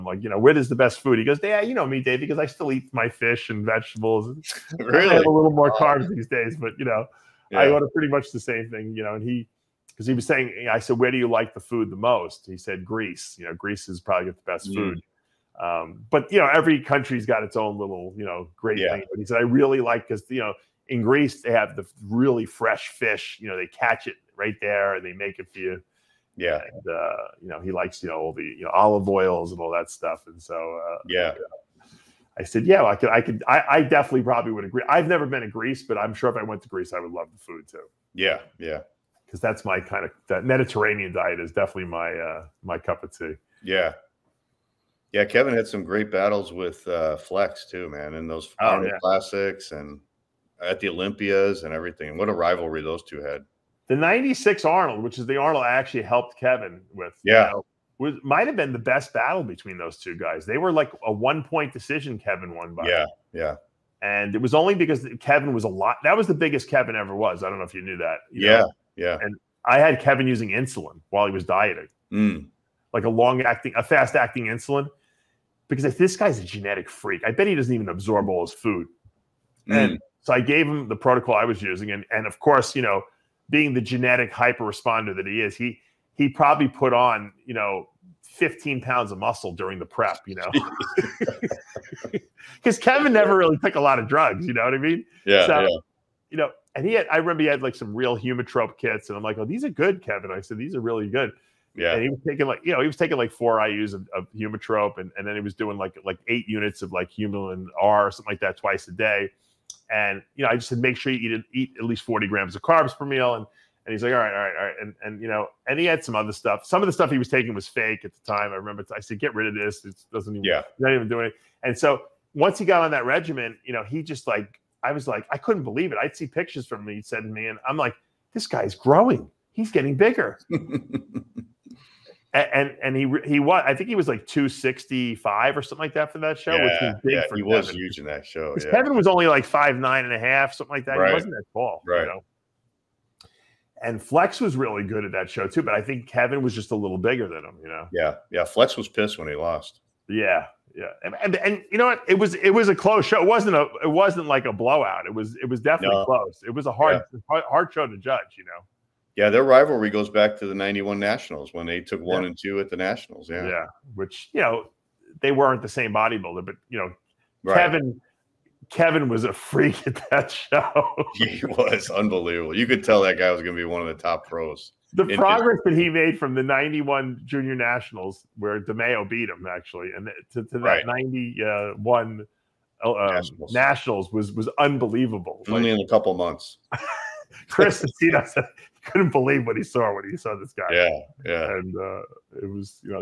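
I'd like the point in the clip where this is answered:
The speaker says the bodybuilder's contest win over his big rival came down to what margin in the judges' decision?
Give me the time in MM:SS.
01:01.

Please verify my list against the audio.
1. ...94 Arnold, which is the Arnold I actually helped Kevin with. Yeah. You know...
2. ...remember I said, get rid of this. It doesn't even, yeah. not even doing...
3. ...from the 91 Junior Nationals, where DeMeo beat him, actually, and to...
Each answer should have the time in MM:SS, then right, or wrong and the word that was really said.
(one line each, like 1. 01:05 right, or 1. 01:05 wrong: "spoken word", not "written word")
1. 00:53 wrong: "96", not "94"
2. 01:58 right
3. 02:56 right.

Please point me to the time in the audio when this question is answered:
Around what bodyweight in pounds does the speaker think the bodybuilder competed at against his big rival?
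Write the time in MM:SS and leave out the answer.
02:14.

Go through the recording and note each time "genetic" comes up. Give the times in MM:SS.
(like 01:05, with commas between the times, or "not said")
01:16, 01:23.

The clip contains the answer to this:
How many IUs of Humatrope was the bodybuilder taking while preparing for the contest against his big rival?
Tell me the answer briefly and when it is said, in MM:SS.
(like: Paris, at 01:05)
4, at 01:43.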